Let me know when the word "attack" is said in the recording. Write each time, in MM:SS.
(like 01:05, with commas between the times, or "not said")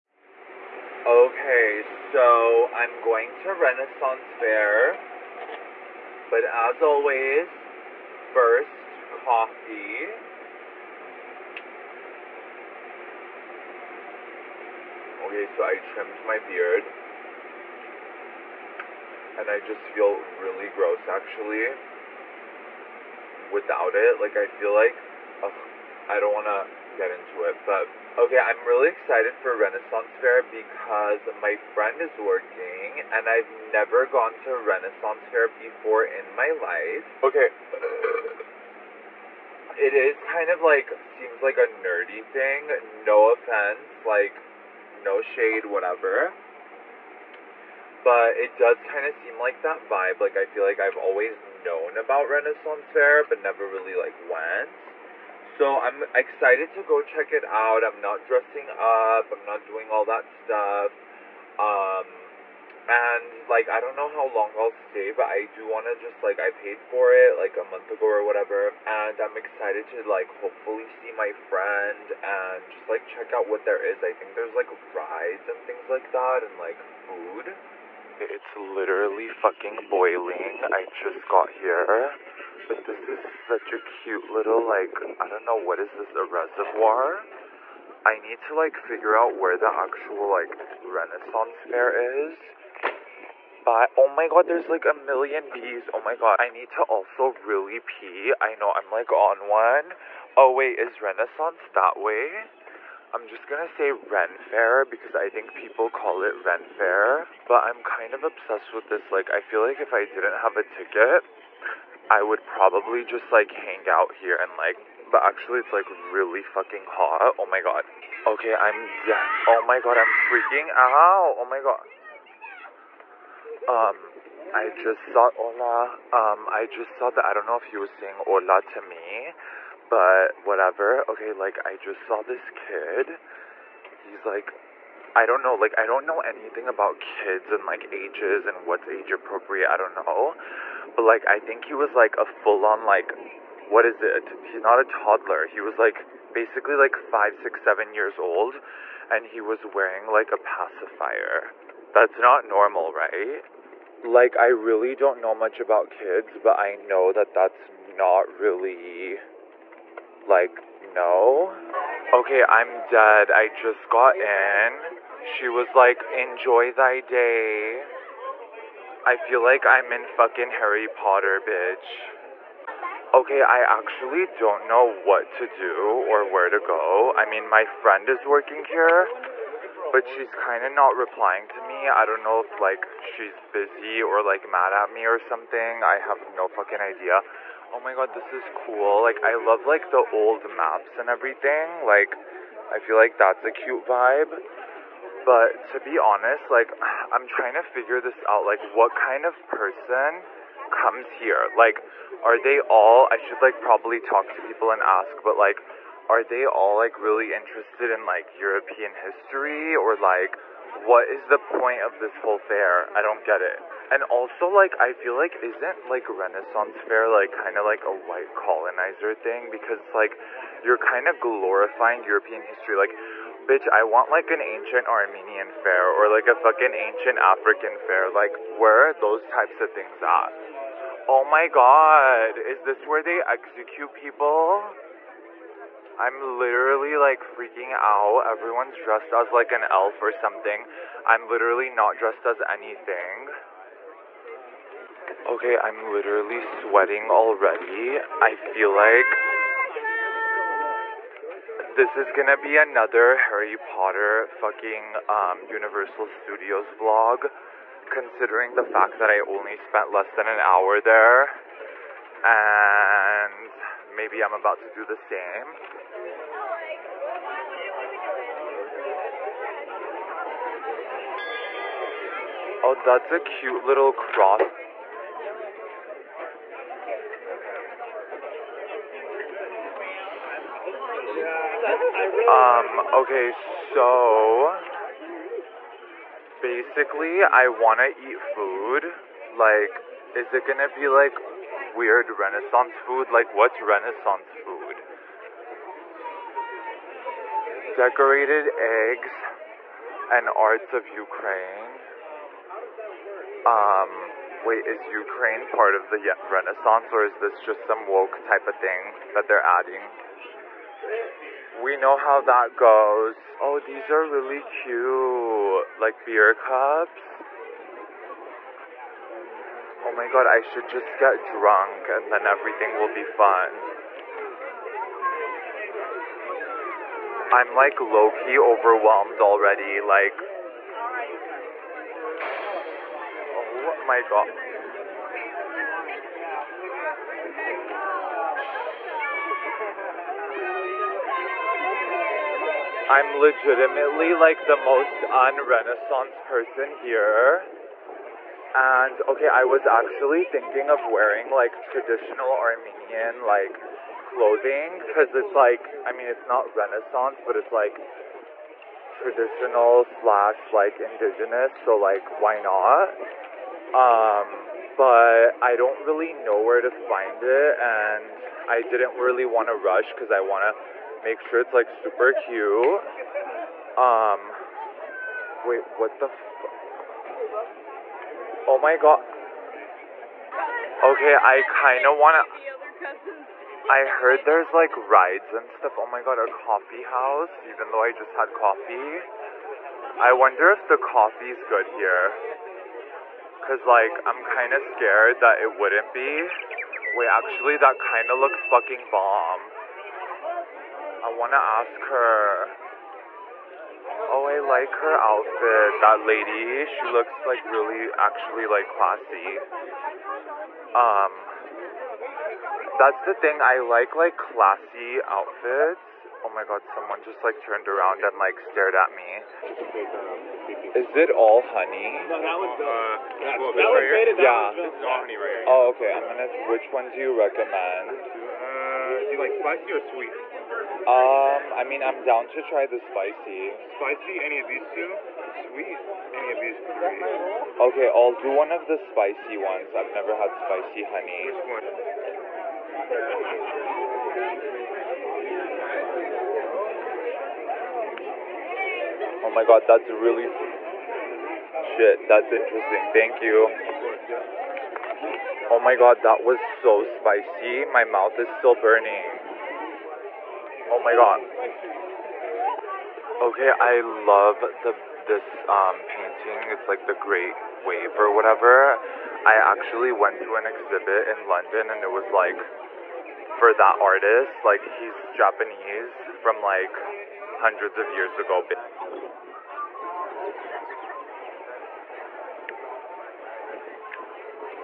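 not said.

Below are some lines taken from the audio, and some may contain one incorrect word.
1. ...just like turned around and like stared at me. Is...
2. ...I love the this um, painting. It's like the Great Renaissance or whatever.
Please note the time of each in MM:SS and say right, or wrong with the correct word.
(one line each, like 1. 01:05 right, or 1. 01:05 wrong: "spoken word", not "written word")
1. 06:57 right
2. 07:43 wrong: "Wave", not "Renaissance".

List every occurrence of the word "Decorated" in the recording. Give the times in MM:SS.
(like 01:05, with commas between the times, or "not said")
04:57.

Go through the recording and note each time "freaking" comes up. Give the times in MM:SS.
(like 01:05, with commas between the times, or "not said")
02:00, 03:57.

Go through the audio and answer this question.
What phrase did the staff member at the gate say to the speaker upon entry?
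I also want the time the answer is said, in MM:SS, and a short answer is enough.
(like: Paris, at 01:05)
Enjoy thy day, at 02:46.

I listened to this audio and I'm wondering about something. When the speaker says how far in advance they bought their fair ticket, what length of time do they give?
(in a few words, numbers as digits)
A month ago.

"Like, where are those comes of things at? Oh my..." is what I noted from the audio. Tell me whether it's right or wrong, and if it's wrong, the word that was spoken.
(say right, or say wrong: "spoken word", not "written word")
wrong: "types", not "comes".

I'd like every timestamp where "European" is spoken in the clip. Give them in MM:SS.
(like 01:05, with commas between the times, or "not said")
03:28, 03:42.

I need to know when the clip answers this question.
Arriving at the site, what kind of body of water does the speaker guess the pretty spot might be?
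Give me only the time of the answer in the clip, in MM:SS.
01:26.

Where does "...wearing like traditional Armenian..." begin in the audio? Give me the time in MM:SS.
05:50.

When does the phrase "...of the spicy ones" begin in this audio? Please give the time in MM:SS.
07:18.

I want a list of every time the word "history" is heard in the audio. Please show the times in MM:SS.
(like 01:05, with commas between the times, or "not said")
03:28, 03:42.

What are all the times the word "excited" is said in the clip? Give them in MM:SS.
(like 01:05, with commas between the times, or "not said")
00:28, 00:56, 01:09.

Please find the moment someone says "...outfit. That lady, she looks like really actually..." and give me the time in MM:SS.
06:44.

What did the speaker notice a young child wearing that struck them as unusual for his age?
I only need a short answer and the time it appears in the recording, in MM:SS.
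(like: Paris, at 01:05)
A pacifier, at 02:30.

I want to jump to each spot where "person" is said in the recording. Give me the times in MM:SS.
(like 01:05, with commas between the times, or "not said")
03:19, 05:46.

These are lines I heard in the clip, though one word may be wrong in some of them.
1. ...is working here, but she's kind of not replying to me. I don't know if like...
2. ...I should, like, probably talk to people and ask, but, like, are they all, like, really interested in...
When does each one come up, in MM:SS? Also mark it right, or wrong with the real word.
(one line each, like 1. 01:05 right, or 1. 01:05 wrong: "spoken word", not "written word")
1. 02:58 right
2. 03:23 right.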